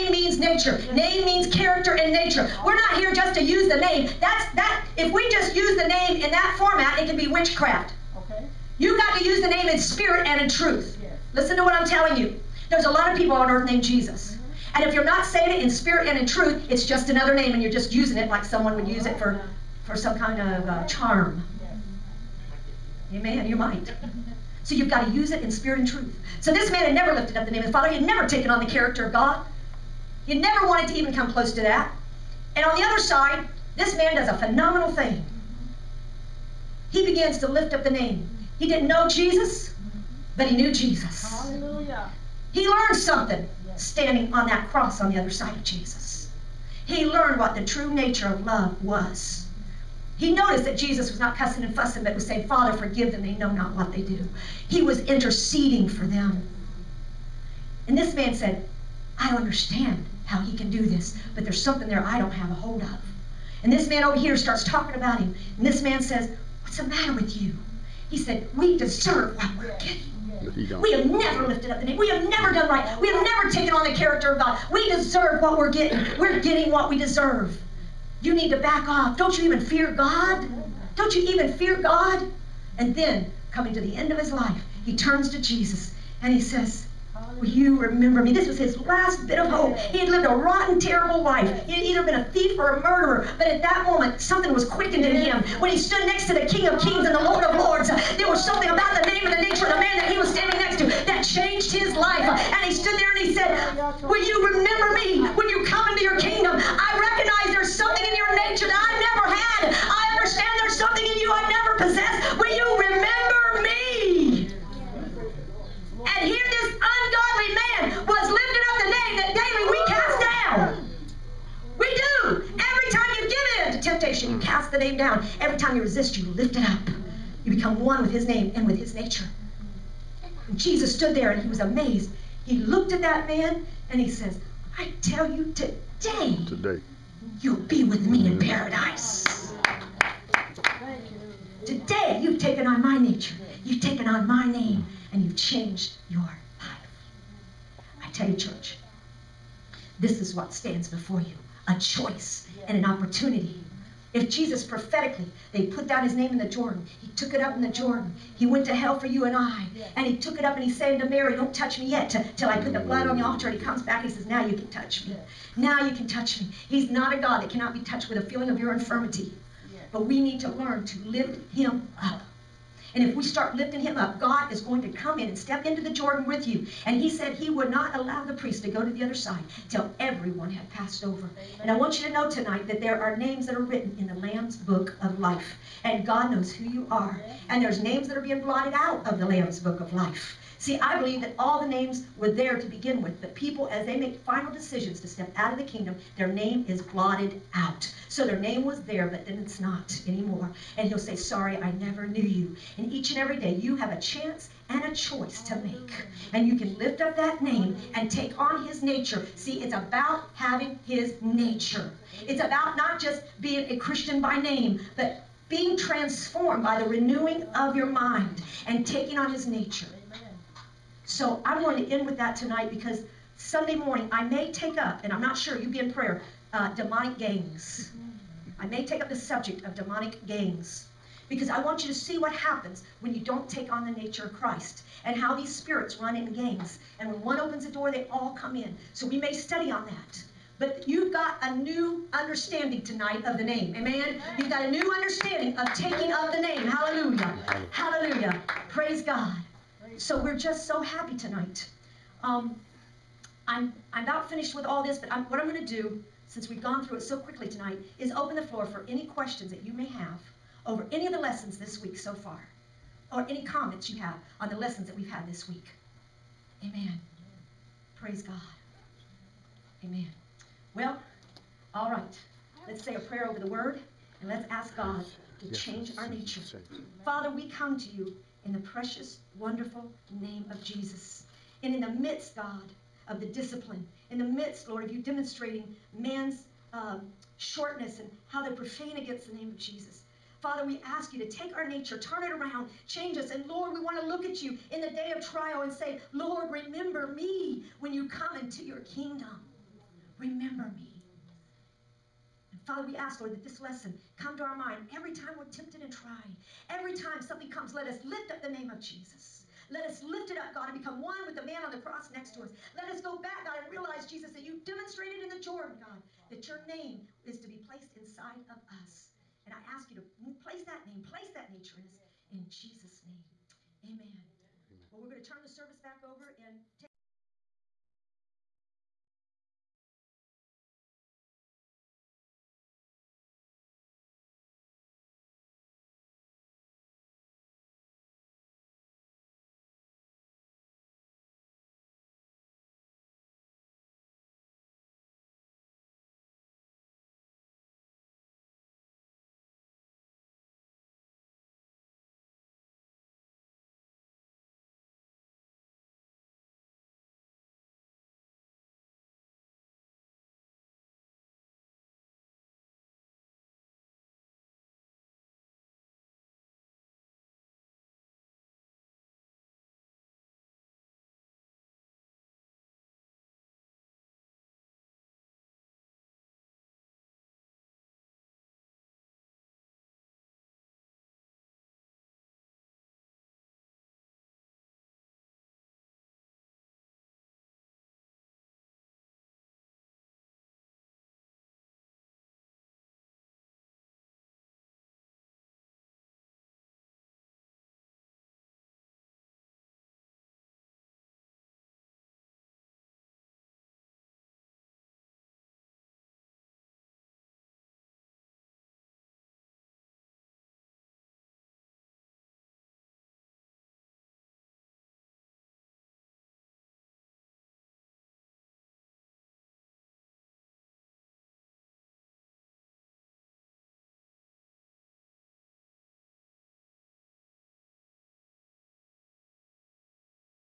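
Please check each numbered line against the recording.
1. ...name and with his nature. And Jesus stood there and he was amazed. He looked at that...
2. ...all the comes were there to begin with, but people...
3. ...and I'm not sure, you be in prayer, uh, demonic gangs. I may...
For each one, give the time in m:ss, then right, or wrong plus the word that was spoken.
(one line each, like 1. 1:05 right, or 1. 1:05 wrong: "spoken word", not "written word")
1. 2:08 right
2. 3:11 wrong: "names", not "comes"
3. 3:45 right.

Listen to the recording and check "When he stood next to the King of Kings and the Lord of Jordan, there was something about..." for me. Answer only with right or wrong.
wrong.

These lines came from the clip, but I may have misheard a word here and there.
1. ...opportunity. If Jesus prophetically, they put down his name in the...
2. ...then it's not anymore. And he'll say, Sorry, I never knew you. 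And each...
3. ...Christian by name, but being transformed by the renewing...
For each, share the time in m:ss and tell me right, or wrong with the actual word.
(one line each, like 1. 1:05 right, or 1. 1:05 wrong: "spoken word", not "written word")
1. 2:32 right
2. 3:19 right
3. 3:33 right.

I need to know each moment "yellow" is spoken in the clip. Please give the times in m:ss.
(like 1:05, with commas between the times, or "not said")
not said.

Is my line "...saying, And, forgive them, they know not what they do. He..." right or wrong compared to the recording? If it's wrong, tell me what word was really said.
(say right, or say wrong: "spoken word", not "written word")
wrong: "Father", not "And".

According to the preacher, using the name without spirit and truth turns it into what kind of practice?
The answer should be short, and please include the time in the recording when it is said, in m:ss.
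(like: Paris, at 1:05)
Witchcraft, at 0:07.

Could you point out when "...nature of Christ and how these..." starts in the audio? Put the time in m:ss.
3:53.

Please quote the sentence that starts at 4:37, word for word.
Father, we come to you in the precious, wonderful name of Jesus.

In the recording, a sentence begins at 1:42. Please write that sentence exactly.
And he stood there and he said, Will you remember me when you come into your kingdom?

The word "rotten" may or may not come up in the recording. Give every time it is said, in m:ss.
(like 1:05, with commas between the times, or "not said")
1:30.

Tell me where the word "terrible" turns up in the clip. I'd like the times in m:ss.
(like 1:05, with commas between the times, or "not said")
1:30.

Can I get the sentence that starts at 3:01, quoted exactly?
And I want you to know tonight that there are names that are written in the Lamb's book of life.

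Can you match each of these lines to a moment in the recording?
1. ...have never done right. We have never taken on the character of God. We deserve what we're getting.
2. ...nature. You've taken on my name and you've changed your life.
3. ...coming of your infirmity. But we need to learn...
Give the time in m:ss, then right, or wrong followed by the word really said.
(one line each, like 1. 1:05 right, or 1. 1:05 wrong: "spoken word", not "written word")
1. 1:12 right
2. 2:22 right
3. 2:48 wrong: "feeling", not "coming".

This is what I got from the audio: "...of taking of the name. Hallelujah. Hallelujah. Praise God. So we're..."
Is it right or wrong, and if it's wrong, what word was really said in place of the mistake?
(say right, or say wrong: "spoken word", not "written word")
right.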